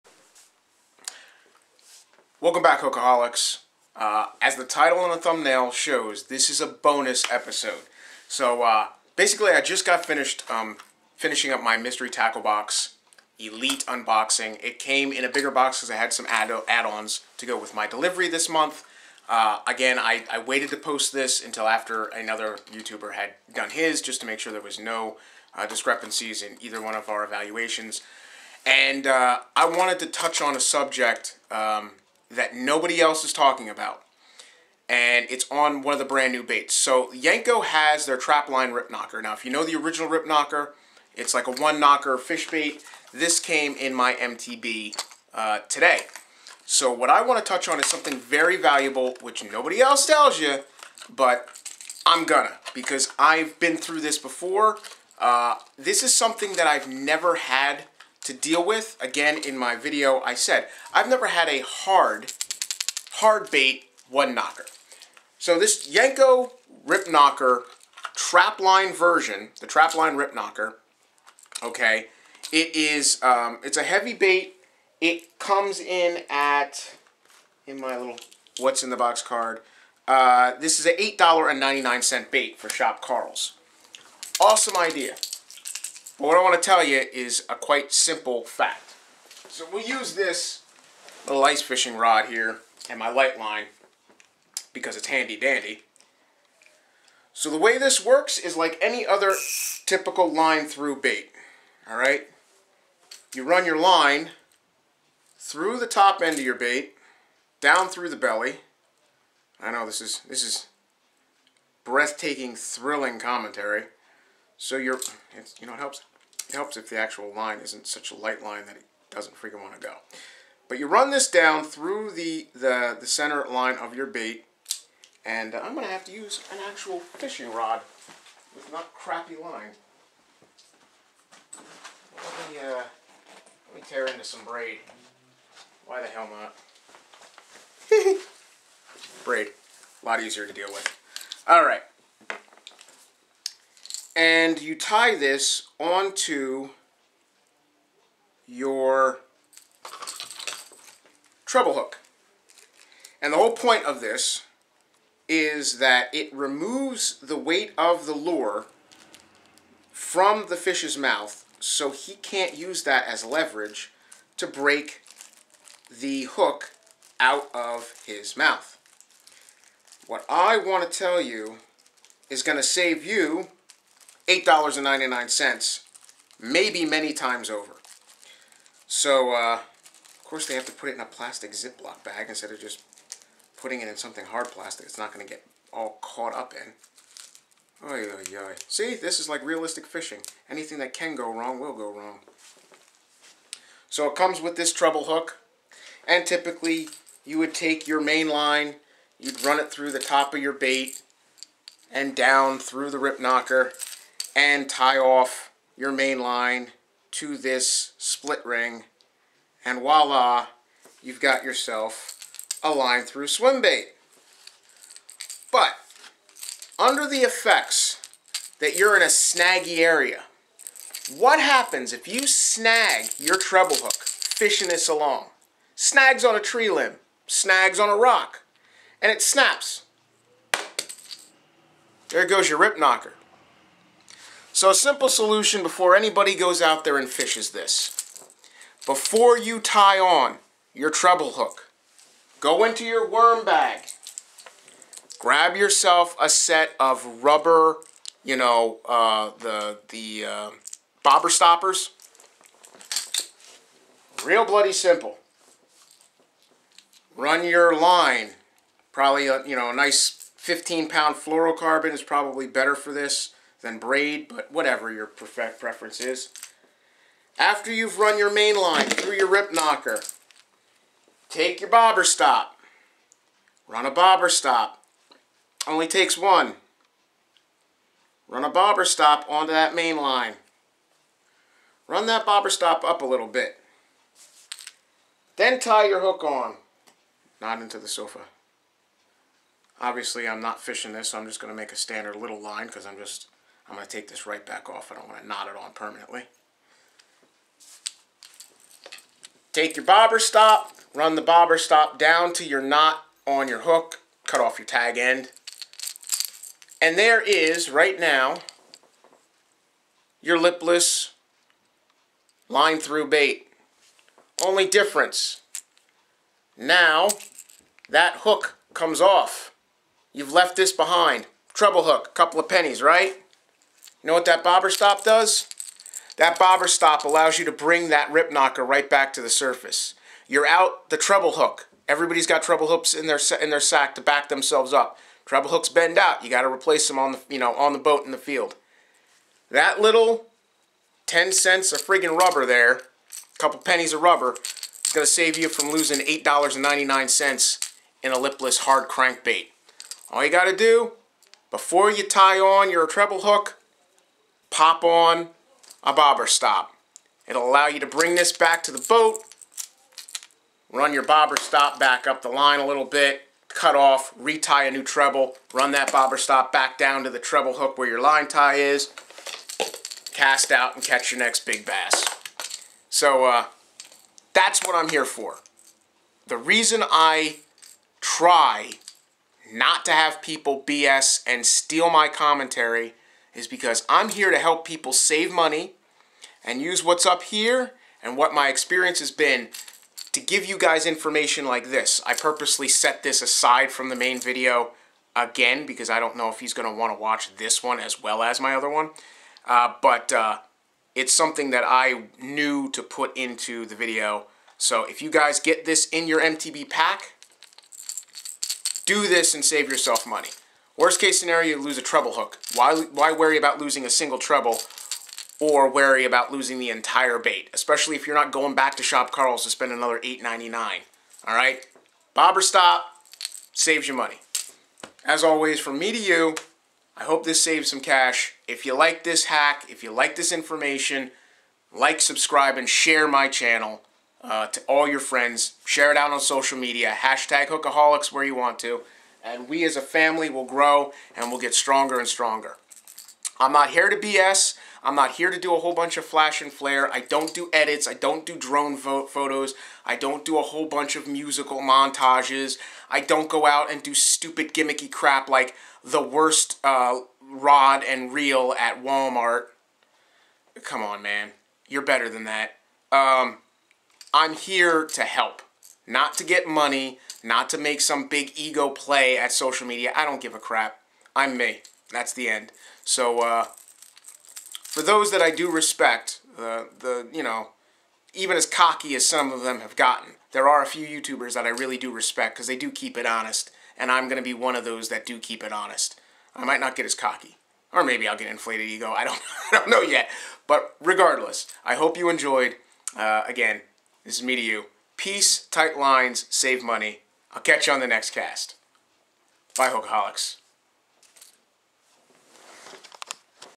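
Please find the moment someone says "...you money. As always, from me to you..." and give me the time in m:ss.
7:03.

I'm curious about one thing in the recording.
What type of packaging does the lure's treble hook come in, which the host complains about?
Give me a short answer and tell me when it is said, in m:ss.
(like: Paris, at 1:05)
plastic Ziploc bag, at 3:01.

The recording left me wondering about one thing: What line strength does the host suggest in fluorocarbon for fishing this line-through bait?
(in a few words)
15 pound.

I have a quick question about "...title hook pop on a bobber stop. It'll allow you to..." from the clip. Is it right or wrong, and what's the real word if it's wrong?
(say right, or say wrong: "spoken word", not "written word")
wrong: "treble", not "title".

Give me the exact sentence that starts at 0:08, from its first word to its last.
So uh, basically, I just got finished um, finishing up my mystery tackle box, elite unboxing.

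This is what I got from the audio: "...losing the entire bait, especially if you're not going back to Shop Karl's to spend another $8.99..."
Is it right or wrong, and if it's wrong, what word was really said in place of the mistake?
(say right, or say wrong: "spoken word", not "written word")
right.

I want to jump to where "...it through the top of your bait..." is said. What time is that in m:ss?
3:19.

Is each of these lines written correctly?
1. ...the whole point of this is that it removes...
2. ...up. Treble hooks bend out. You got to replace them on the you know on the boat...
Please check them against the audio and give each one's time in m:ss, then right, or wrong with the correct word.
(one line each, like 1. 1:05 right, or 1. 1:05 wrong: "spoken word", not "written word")
1. 2:33 right
2. 5:34 right.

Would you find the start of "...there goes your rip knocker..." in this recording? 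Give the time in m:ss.
3:52.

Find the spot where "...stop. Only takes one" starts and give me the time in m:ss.
4:34.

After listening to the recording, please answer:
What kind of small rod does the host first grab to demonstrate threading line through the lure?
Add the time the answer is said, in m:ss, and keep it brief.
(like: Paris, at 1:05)
ice fishing rod, at 1:31.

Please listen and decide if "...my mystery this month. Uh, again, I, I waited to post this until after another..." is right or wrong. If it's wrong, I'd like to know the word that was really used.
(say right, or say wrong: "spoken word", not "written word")
wrong: "delivery", not "mystery".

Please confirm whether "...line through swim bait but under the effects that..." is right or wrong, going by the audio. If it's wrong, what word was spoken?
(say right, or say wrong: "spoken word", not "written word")
right.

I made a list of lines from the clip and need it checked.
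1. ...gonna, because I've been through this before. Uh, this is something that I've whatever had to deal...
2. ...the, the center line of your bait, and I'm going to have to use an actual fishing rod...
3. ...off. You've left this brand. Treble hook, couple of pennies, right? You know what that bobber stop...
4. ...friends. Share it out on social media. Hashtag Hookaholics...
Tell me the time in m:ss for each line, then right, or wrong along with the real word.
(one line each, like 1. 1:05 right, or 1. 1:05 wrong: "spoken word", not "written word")
1. 0:52 wrong: "never", not "whatever"
2. 2:02 right
3. 5:18 wrong: "behind", not "brand"
4. 7:14 right.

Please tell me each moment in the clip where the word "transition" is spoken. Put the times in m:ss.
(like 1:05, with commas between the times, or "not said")
not said.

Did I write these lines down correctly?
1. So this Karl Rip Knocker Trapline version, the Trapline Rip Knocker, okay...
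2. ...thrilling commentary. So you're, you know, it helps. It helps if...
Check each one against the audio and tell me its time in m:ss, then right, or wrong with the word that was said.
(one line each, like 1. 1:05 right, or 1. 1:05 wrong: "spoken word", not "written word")
1. 1:05 wrong: "Jenko", not "Karl"
2. 1:52 right.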